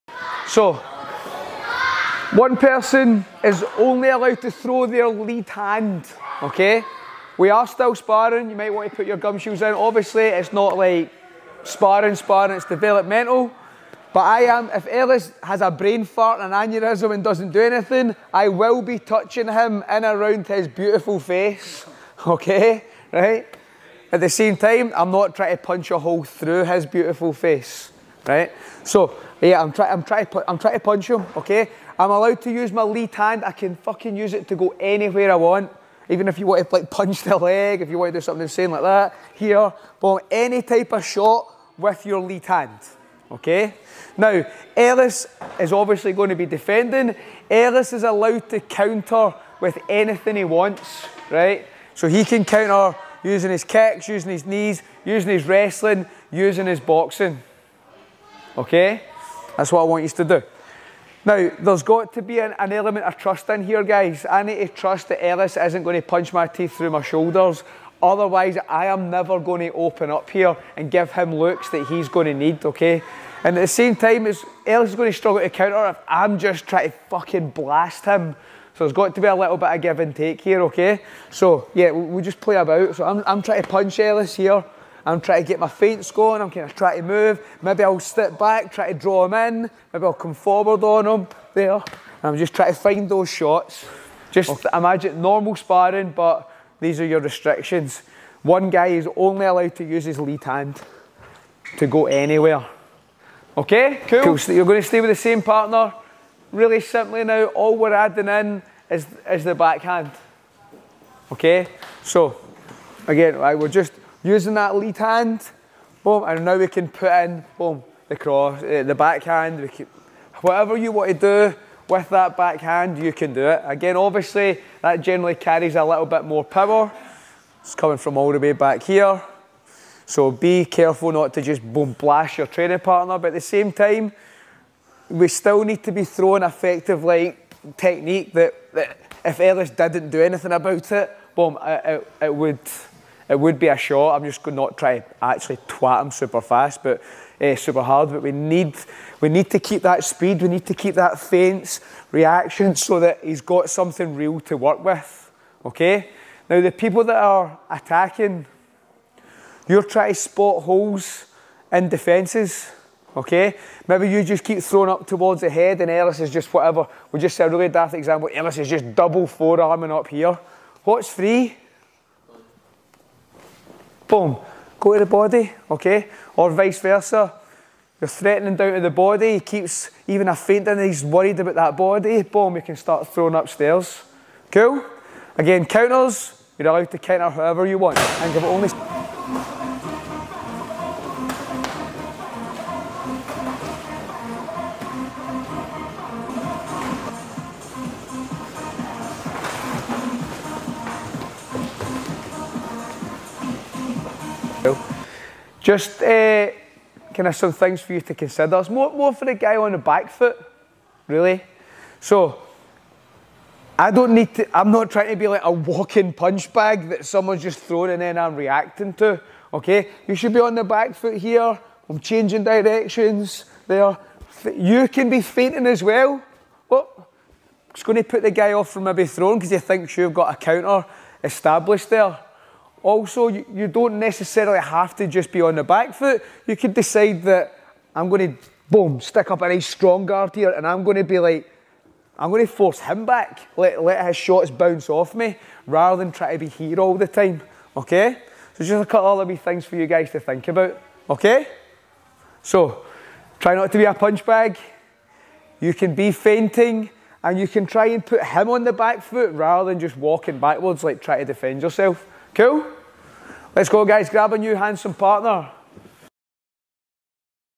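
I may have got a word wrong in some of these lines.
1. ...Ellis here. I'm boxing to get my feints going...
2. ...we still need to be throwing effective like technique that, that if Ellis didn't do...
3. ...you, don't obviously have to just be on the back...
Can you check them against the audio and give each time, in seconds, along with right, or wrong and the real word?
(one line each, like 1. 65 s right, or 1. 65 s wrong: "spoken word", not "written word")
1. 83 s wrong: "trying", not "boxing"
2. 135 s right
3. 233 s wrong: "necessarily", not "obviously".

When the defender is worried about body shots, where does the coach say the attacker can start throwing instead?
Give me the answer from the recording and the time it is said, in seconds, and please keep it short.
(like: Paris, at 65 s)
upstairs, at 183 s.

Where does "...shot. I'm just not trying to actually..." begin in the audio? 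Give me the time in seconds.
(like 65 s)
143 s.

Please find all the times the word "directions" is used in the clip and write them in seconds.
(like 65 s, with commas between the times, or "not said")
222 s.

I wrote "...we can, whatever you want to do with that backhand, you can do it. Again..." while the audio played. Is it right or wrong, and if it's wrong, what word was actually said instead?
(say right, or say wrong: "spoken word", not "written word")
right.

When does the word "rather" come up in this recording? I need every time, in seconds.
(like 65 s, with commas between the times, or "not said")
245 s, 259 s.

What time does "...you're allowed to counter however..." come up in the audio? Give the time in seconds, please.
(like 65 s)
186 s.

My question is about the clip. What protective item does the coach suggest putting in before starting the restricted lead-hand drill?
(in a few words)
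gumshoes.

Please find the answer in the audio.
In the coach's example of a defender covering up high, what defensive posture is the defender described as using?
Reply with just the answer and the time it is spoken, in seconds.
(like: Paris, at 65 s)
double forearming, at 168 s.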